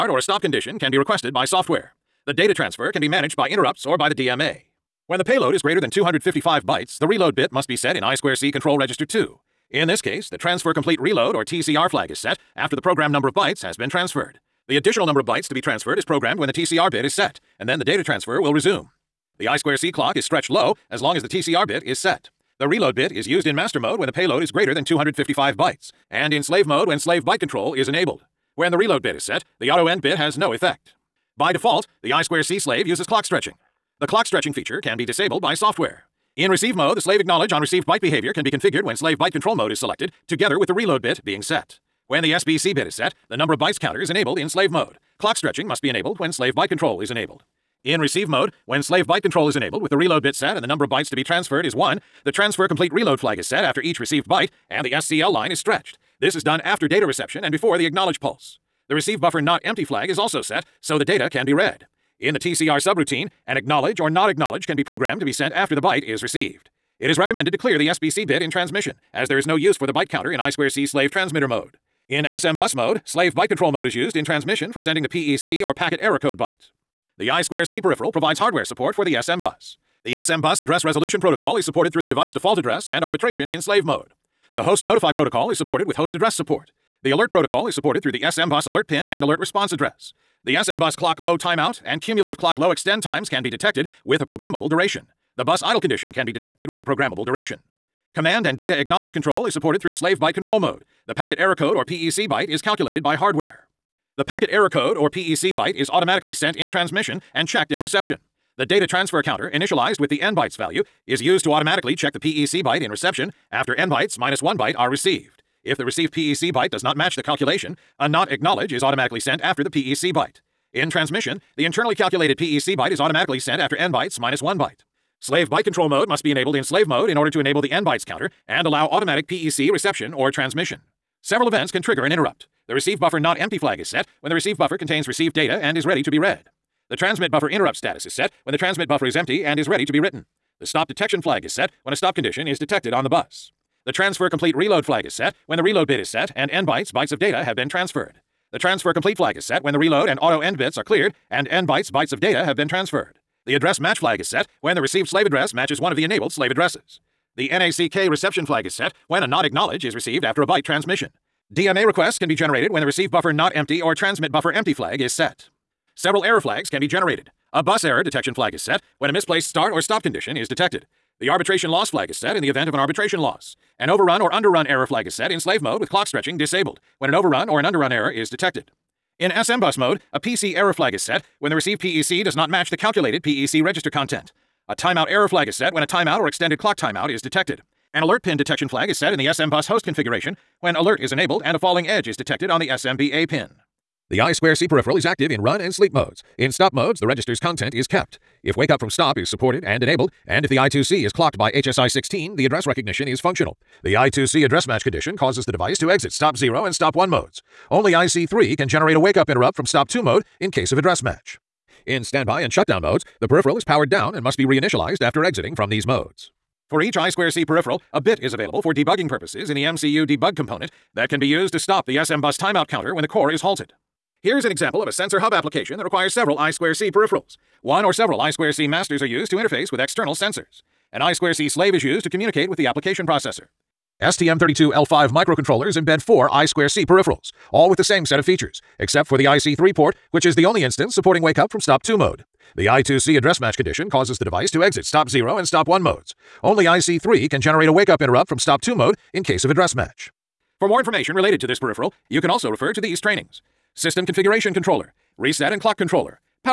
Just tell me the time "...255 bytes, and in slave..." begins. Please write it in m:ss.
0:24.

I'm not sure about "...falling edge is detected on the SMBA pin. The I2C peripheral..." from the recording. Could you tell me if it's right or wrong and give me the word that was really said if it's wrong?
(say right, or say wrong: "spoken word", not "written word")
right.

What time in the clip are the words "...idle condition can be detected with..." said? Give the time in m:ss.
1:35.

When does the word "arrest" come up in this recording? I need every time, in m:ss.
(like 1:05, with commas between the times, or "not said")
not said.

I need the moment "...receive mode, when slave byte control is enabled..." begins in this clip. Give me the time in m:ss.
0:48.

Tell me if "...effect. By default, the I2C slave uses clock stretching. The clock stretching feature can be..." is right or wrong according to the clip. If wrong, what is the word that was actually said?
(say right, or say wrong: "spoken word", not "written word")
right.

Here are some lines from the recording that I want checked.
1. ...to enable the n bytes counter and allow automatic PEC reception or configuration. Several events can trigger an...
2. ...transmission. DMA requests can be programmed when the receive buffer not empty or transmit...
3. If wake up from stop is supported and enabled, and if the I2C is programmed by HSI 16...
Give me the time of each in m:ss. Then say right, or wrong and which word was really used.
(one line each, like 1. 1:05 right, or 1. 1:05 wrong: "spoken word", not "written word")
1. 2:07 wrong: "transmission", not "configuration"
2. 2:40 wrong: "generated", not "programmed"
3. 3:18 wrong: "clocked", not "programmed".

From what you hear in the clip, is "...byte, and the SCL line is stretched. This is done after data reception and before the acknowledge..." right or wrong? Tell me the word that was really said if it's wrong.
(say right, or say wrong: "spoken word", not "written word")
right.